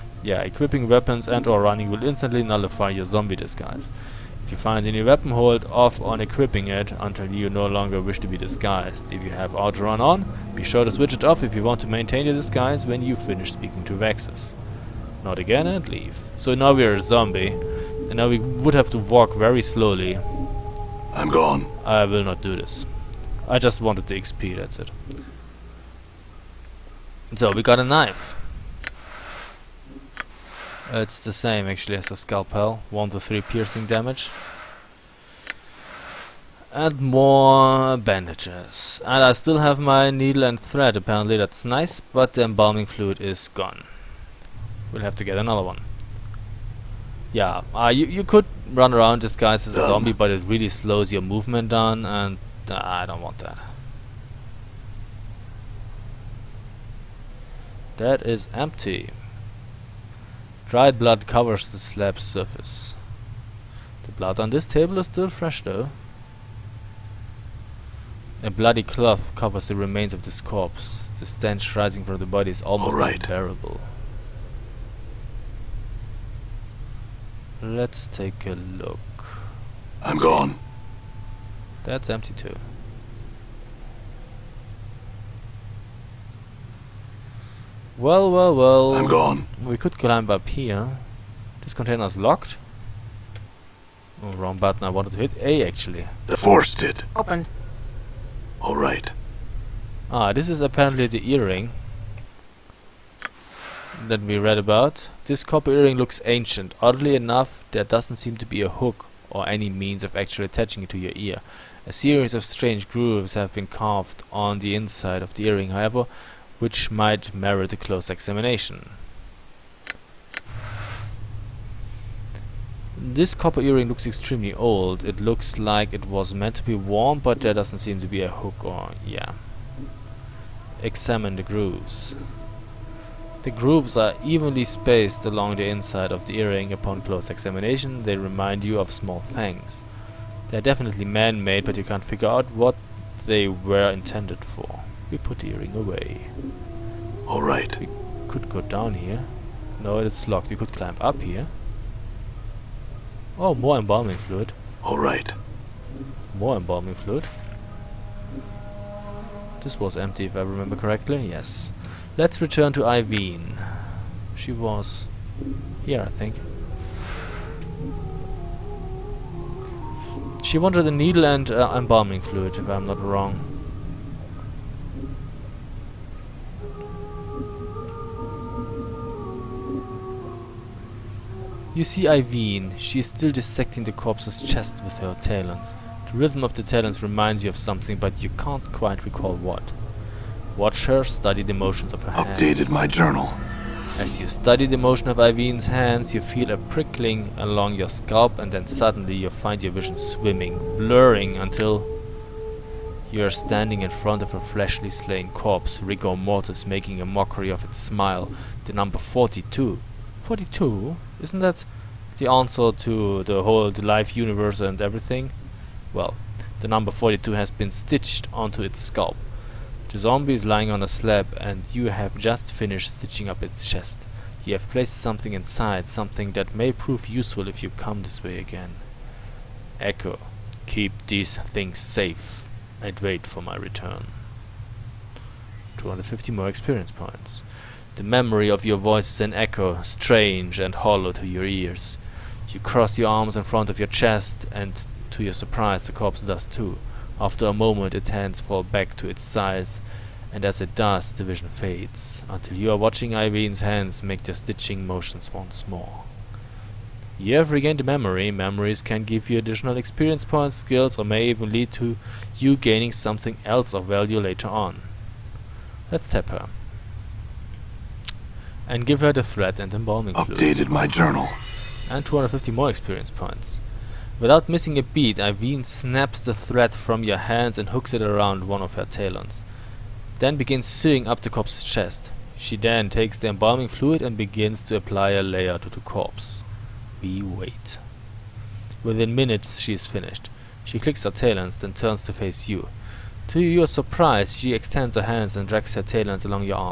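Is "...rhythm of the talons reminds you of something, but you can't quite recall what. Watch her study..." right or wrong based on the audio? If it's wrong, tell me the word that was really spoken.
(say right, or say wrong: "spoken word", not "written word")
right.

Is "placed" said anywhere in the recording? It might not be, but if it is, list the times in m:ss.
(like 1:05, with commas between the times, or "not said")
3:44.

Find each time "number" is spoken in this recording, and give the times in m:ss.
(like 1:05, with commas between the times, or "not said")
3:28, 3:36.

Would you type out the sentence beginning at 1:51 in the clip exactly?
A series of strange grooves have been carved on the inside of the earring, however, which might merit a close examination.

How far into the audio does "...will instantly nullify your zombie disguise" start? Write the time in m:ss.
0:01.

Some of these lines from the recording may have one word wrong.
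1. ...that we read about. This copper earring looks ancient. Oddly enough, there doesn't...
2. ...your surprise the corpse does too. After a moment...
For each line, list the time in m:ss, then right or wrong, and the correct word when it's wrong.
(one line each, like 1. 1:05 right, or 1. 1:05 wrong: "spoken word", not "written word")
1. 1:44 right
2. 4:05 right.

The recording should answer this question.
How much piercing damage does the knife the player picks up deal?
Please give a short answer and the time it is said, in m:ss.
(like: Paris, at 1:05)
1 to 3, at 0:32.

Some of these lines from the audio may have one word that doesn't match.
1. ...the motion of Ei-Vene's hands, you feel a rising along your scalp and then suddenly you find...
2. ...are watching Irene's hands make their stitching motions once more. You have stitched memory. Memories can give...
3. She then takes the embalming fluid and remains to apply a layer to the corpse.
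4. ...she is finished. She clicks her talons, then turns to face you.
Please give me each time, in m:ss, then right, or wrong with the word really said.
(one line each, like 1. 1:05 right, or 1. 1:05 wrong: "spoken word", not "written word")
1. 3:14 wrong: "prickling", not "rising"
2. 4:12 wrong: "regained", not "stitched"
3. 4:42 wrong: "begins", not "remains"
4. 4:49 right.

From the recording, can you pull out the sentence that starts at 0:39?
And I still have my needle and thread apparently, that's nice, but the embalming fluid is gone.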